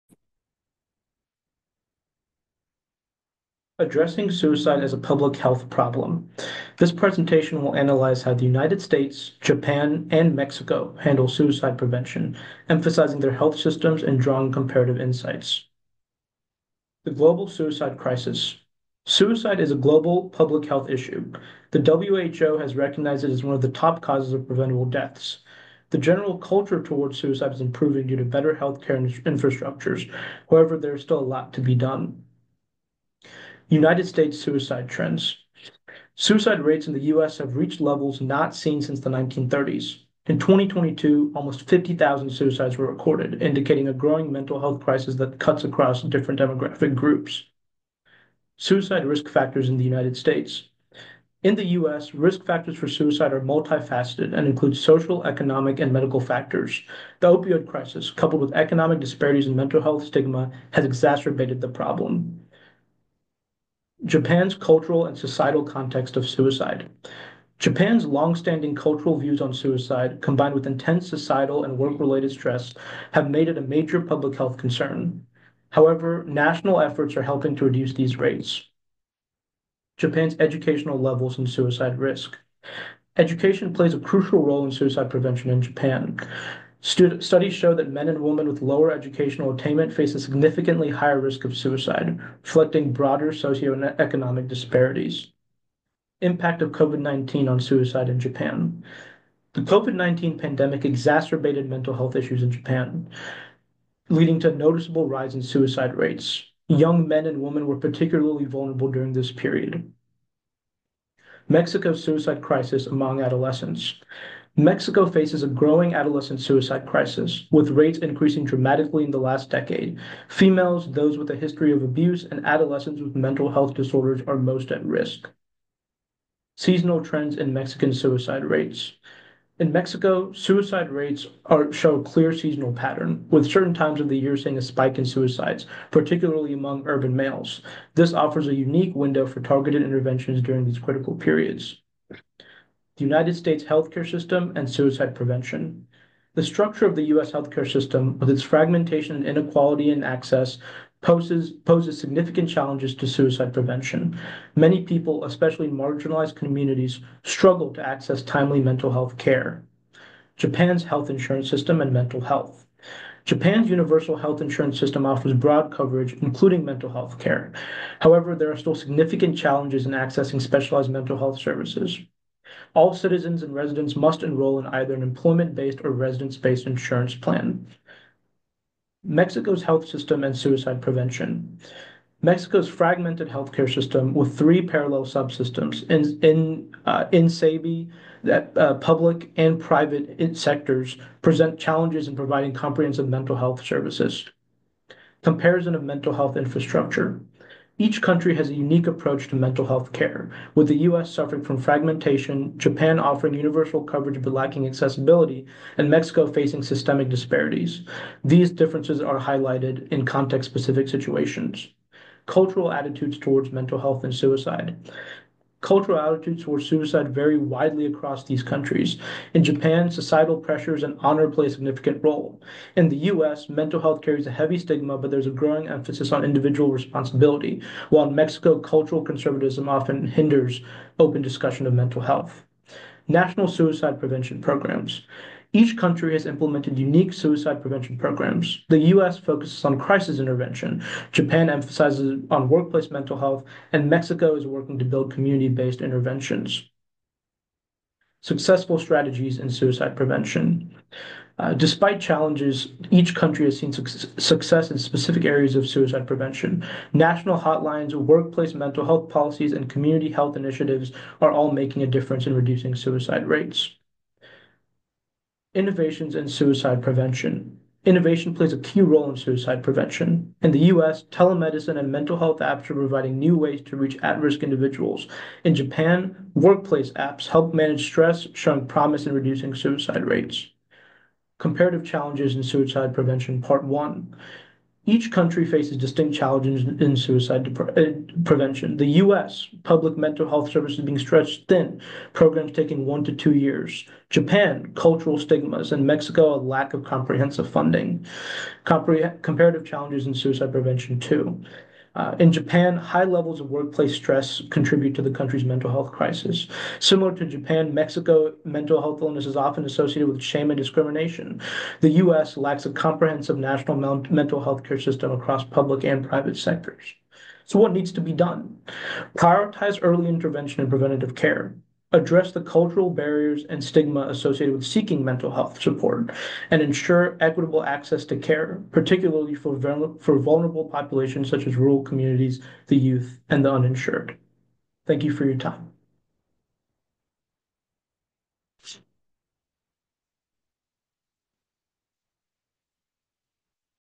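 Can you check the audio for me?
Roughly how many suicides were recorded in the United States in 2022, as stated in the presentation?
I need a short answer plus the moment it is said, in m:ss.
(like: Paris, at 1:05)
almost 50,000, at 0:41.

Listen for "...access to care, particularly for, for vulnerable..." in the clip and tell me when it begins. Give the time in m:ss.
5:27.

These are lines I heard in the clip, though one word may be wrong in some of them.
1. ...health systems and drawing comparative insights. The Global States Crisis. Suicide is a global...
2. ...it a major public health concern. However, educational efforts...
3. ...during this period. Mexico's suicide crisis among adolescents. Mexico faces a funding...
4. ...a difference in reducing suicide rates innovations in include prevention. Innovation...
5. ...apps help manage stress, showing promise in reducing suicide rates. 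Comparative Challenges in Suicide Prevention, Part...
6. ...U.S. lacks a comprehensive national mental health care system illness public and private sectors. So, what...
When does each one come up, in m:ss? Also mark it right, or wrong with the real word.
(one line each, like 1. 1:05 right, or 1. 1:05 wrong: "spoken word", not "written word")
1. 0:13 wrong: "Suicide", not "States"
2. 1:13 wrong: "national", not "educational"
3. 1:48 wrong: "growing", not "funding"
4. 4:21 wrong: "suicide", not "include"
5. 4:36 right
6. 5:11 wrong: "across", not "illness".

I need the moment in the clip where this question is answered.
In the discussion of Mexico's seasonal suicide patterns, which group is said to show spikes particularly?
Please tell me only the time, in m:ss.
2:16.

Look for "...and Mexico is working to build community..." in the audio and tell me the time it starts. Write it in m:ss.
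4:03.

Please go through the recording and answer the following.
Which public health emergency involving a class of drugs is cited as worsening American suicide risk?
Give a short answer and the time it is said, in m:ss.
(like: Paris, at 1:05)
opioid crisis, at 0:57.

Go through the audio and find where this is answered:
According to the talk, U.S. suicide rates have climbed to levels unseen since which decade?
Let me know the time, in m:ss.
0:39.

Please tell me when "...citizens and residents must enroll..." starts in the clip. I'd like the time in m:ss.
2:52.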